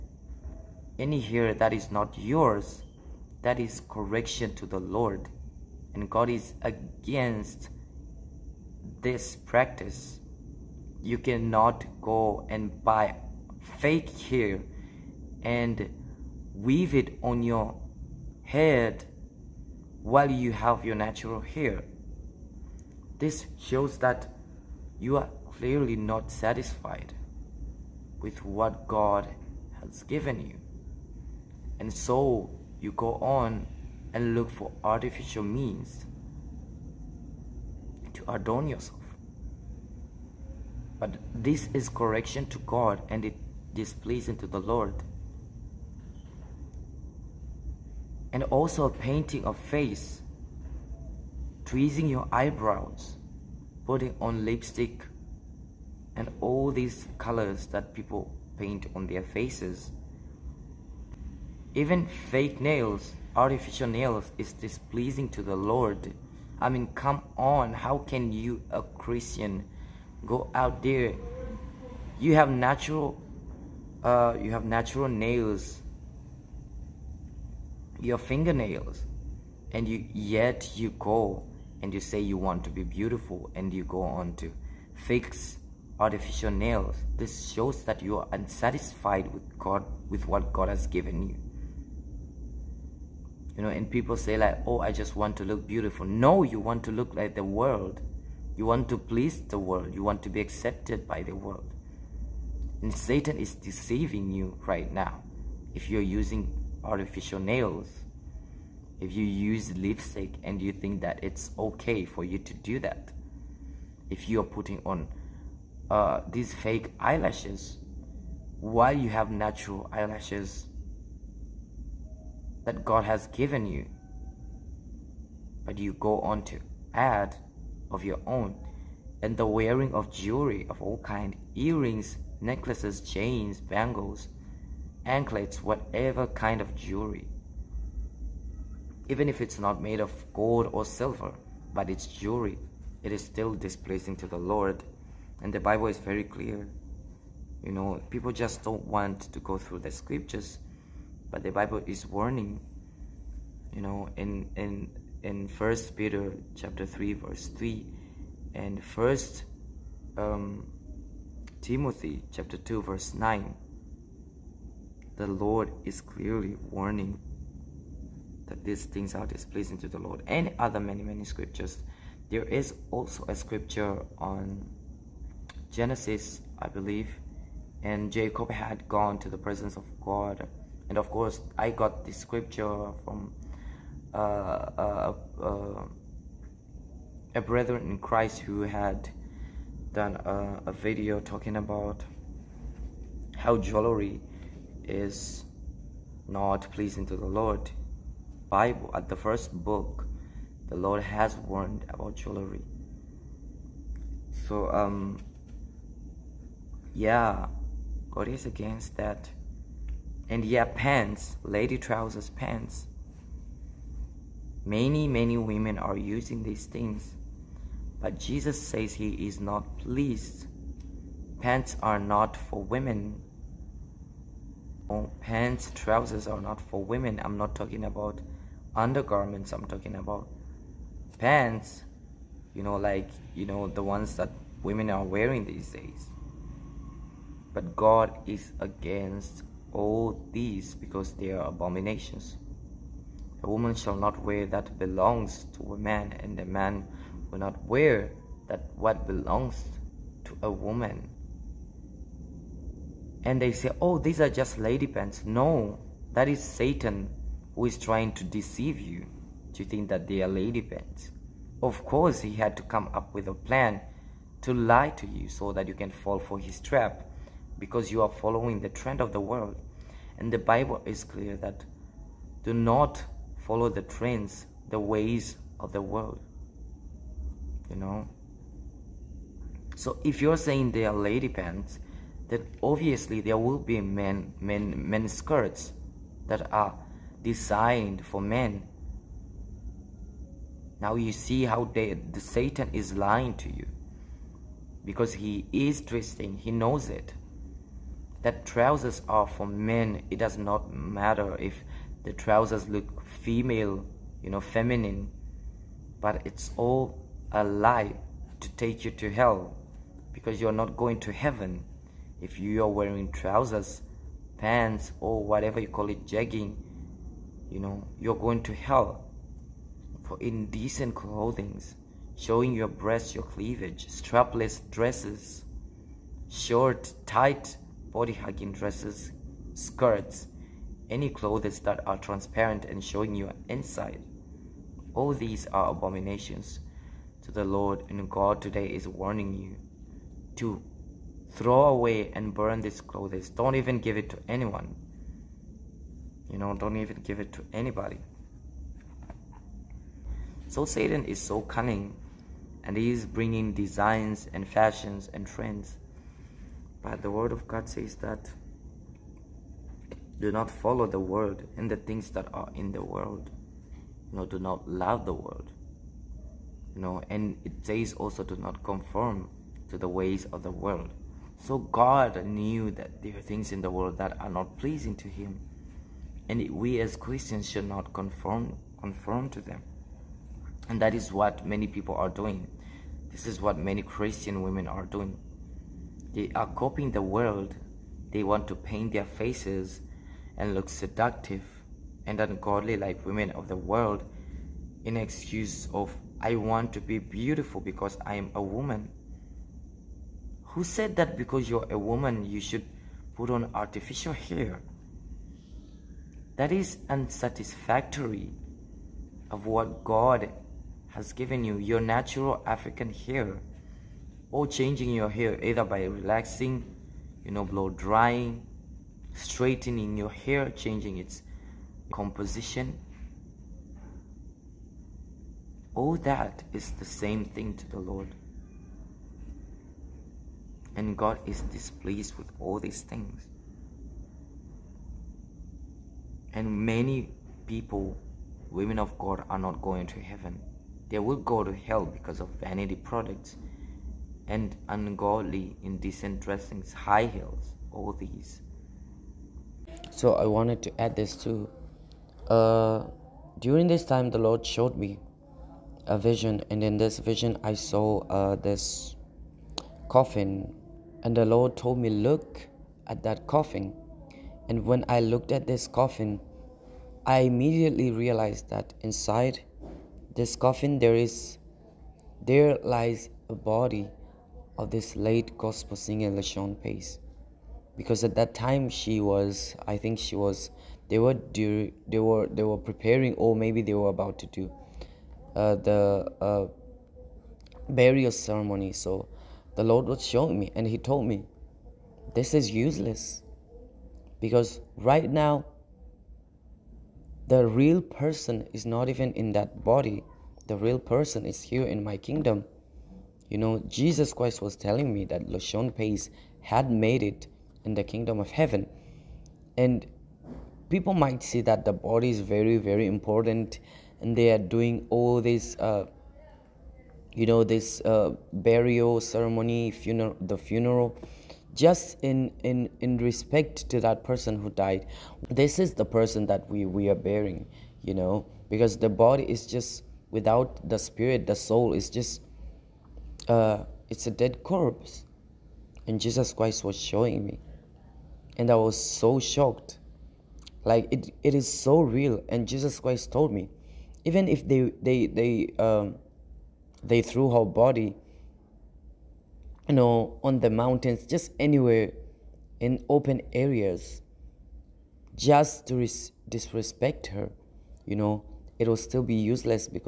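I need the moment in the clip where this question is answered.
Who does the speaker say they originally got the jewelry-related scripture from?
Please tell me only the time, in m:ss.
3:07.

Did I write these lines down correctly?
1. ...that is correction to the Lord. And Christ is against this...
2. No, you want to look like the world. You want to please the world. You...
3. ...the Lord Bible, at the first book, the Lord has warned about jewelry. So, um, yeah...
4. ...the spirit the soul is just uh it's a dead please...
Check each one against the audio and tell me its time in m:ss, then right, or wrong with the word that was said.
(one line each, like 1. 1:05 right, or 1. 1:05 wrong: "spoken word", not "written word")
1. 0:03 wrong: "God", not "Christ"
2. 1:36 right
3. 3:17 right
4. 8:50 wrong: "corpse", not "please".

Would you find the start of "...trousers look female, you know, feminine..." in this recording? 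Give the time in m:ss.
5:02.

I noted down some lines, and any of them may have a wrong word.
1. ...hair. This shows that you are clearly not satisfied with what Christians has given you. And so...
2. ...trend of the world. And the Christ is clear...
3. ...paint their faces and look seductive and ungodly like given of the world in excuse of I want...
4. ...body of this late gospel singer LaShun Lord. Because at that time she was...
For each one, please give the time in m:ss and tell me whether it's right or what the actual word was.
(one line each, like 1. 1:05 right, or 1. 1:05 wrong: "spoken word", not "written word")
1. 0:21 wrong: "God", not "Christians"
2. 4:28 wrong: "Bible", not "Christ"
3. 6:28 wrong: "women", not "given"
4. 7:53 wrong: "Pace", not "Lord".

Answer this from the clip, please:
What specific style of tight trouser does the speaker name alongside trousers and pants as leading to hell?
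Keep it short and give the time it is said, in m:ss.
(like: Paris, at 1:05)
jegging, at 5:16.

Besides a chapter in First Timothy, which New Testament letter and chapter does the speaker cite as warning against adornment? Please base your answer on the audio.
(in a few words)
First Peter chapter 3.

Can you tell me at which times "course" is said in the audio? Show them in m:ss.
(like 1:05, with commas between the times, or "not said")
3:01, 4:21.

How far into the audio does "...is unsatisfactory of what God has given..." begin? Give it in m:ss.
6:46.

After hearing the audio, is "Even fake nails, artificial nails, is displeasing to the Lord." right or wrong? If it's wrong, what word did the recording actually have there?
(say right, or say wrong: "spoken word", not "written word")
right.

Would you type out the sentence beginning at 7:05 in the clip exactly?
All that is the same thing to the Lord.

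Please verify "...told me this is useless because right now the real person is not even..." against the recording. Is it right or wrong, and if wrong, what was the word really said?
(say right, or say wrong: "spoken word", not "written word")
right.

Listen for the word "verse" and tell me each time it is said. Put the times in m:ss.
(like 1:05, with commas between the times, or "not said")
2:37, 2:42.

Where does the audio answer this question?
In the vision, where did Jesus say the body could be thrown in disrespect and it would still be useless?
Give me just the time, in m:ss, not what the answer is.
9:10.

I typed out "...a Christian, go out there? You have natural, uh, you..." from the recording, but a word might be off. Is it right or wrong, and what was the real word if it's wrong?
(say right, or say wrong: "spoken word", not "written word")
right.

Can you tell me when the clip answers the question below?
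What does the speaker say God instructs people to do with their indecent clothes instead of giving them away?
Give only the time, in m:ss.
5:41.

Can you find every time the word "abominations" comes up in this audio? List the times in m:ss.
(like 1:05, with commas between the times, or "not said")
4:01, 5:35.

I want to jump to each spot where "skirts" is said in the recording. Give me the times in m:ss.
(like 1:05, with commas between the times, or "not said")
4:45, 5:29.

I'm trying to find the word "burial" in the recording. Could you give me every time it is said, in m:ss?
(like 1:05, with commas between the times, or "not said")
8:07, 8:38.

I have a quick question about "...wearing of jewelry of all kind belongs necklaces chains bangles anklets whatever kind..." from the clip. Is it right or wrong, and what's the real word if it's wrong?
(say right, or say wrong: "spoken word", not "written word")
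wrong: "earrings", not "belongs".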